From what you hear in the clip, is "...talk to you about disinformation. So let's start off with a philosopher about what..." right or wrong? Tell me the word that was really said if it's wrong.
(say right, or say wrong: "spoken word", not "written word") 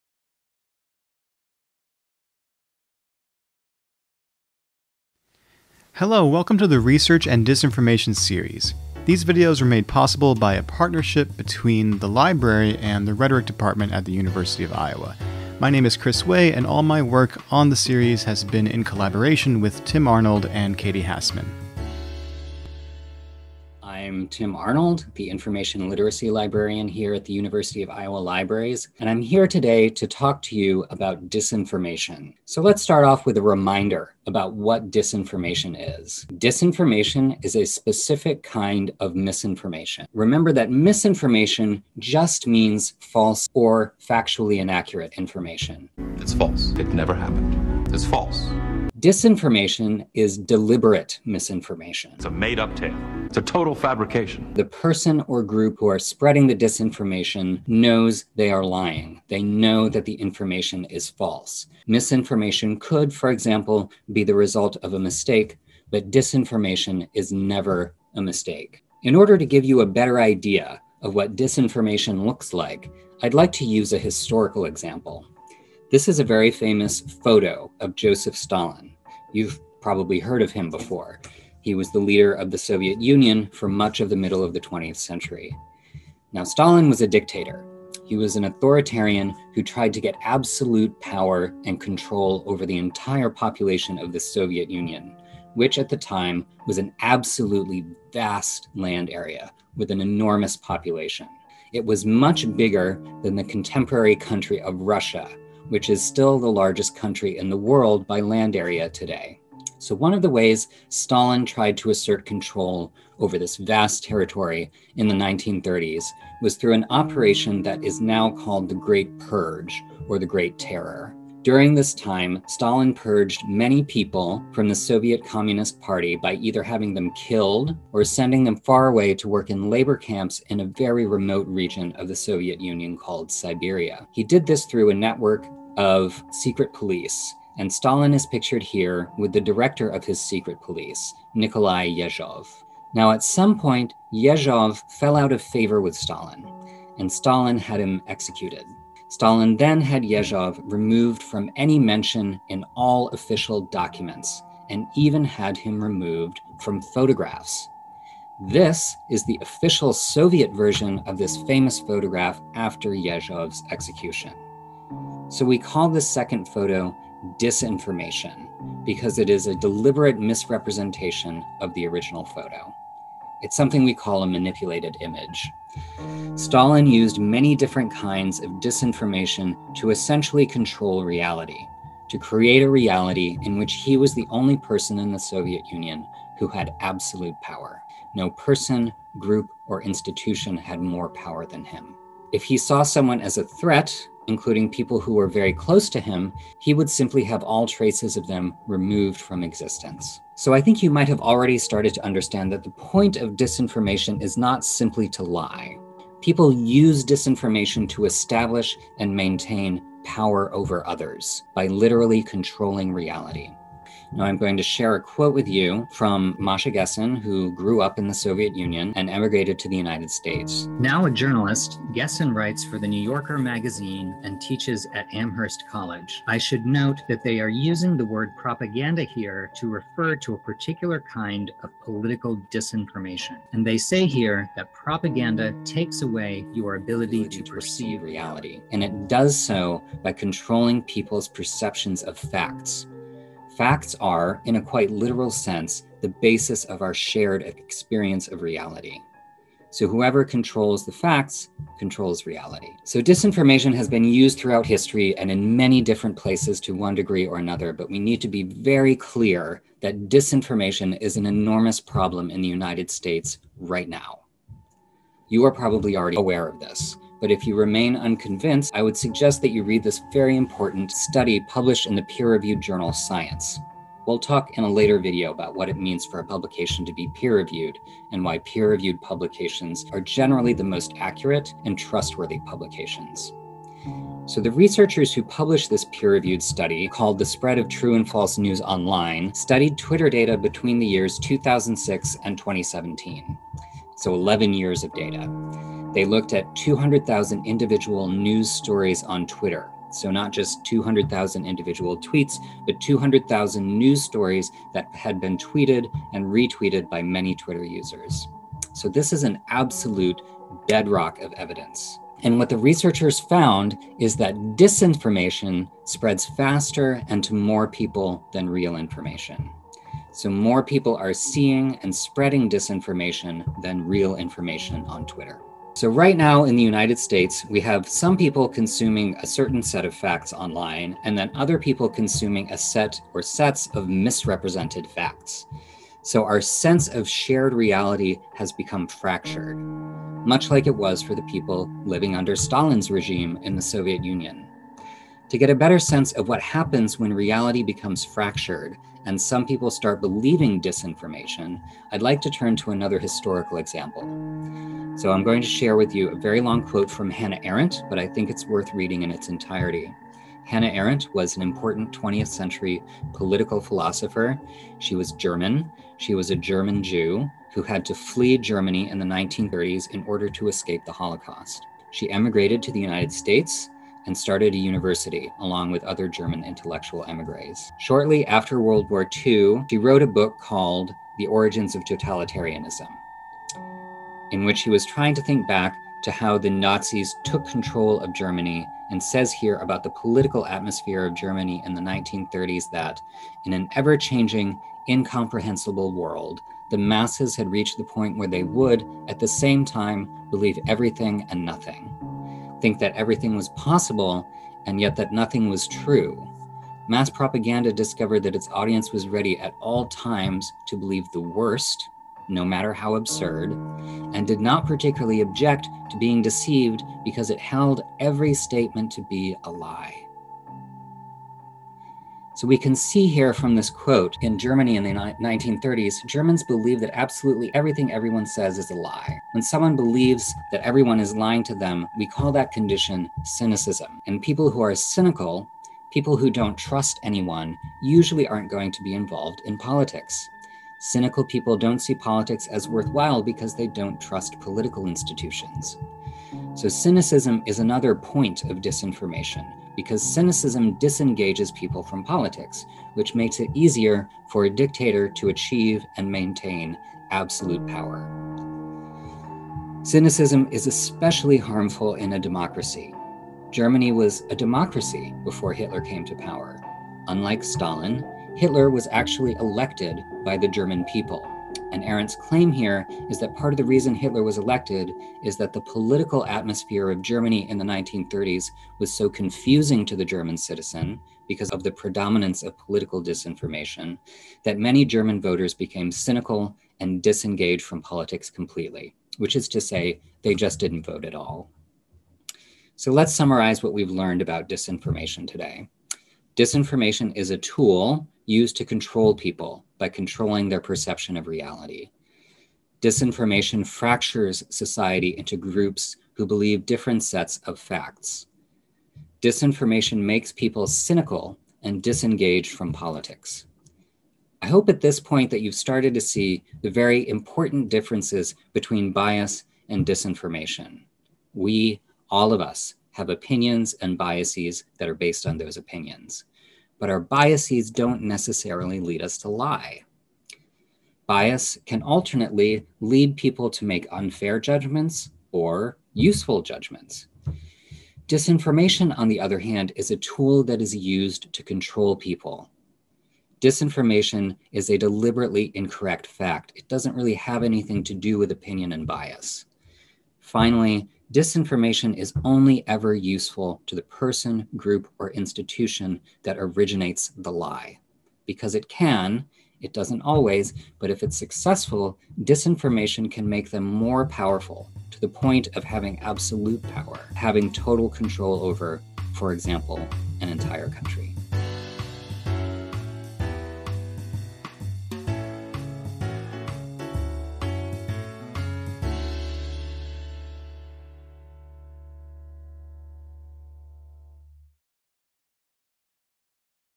wrong: "reminder", not "philosopher".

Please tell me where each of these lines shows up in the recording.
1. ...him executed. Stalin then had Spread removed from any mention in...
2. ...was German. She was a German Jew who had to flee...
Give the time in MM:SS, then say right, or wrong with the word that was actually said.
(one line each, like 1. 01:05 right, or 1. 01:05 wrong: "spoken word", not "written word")
1. 02:27 wrong: "Yezhov", not "Spread"
2. 06:04 right.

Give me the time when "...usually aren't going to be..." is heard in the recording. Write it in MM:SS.
07:17.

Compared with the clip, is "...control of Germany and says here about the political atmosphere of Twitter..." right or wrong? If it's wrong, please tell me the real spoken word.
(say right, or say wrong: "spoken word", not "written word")
wrong: "Germany", not "Twitter".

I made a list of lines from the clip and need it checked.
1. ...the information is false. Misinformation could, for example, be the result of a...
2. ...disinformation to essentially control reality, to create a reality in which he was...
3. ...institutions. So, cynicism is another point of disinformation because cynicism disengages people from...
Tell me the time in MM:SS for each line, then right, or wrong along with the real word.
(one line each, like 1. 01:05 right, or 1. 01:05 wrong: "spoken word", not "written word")
1. 01:00 right
2. 02:58 right
3. 07:24 right.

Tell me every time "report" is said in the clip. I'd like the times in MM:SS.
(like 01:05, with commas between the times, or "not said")
not said.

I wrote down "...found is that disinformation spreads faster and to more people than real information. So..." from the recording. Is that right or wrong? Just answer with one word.
right.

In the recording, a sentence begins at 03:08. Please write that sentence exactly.
No person, group, or institution had more power than him.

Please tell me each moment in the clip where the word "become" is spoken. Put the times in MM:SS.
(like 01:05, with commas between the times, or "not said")
05:38, 05:47.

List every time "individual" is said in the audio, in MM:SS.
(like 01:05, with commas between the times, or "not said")
04:57, 05:01.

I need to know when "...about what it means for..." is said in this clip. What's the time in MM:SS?
04:35.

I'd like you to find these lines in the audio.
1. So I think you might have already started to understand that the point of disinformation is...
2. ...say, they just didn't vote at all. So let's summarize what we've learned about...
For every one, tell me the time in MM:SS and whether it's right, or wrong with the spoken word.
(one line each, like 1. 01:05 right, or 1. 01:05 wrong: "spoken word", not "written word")
1. 03:20 right
2. 08:09 right.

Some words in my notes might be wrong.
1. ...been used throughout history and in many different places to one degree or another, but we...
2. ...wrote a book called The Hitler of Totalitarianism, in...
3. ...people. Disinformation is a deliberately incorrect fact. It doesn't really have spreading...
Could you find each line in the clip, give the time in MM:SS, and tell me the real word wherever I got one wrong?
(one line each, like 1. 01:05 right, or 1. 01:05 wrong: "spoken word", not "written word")
1. 04:13 right
2. 06:19 wrong: "Origins", not "Hitler"
3. 09:01 wrong: "anything", not "spreading".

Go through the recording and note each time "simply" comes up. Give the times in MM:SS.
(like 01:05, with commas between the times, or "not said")
03:16, 03:24.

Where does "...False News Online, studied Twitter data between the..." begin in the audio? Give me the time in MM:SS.
04:48.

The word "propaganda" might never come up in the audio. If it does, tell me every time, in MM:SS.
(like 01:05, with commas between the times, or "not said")
03:48, 03:54, 06:47.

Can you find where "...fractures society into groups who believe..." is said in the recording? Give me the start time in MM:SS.
08:23.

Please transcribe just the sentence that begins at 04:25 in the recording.
You are probably already aware of this.